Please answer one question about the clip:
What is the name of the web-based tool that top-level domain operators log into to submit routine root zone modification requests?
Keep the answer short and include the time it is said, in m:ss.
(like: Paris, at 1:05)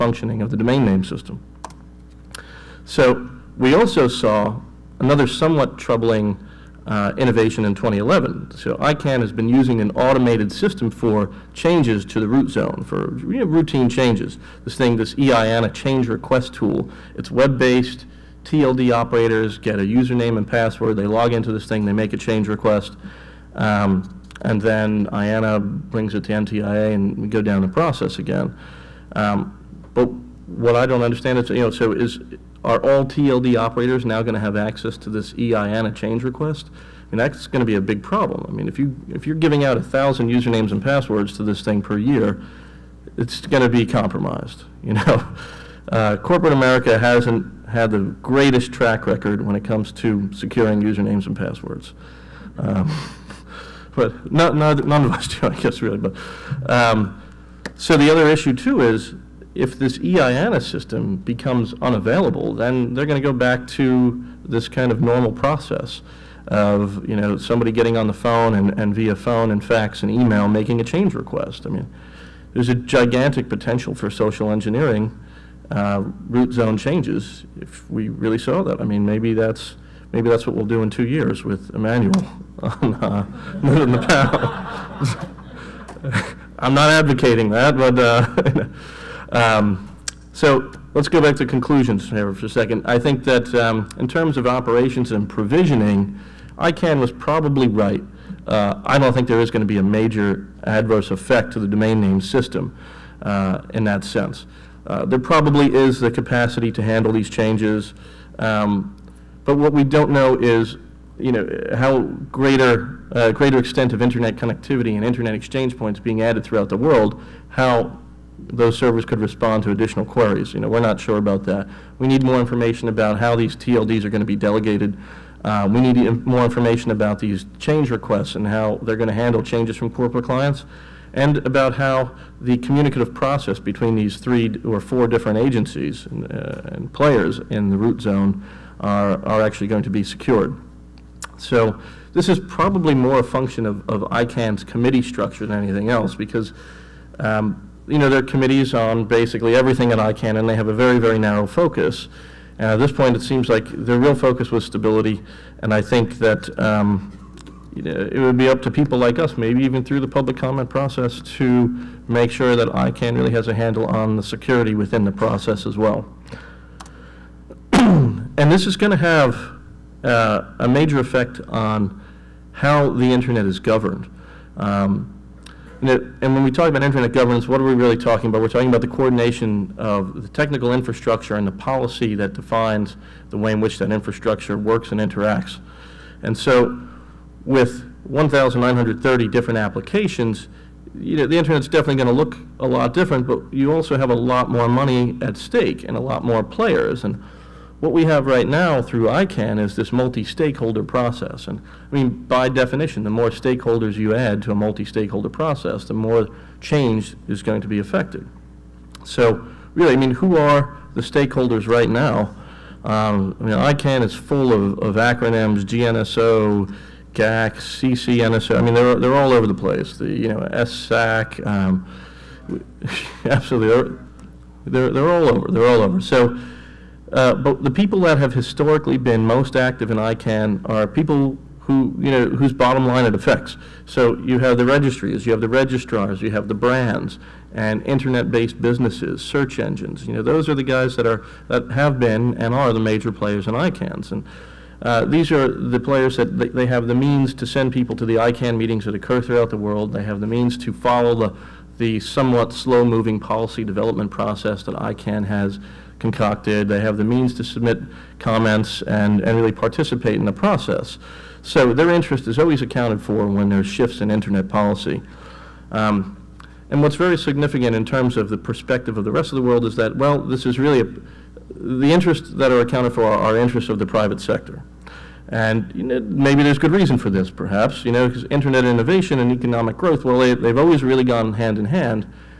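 EIANA change request tool, at 0:15.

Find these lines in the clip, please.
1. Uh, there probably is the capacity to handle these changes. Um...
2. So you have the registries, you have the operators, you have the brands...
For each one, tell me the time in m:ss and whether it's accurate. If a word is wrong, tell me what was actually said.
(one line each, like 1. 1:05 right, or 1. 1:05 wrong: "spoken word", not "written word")
1. 1:44 right
2. 3:53 wrong: "registrars", not "operators".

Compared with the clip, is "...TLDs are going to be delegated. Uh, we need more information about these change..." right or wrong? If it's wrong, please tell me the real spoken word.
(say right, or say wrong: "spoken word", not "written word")
right.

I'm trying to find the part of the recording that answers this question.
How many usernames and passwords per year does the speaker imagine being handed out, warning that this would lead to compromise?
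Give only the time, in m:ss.
0:39.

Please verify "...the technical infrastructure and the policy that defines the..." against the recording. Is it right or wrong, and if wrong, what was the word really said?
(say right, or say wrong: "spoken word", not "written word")
right.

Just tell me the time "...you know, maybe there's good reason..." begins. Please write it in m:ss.
4:35.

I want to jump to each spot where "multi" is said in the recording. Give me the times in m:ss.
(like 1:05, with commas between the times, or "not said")
3:19, 3:24.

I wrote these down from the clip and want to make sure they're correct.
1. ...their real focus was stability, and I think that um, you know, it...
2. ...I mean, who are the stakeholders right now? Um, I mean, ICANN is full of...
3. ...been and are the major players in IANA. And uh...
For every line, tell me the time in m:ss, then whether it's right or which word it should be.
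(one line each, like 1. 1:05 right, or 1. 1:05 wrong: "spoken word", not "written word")
1. 2:33 right
2. 3:29 right
3. 4:01 wrong: "ICANNs", not "IANA".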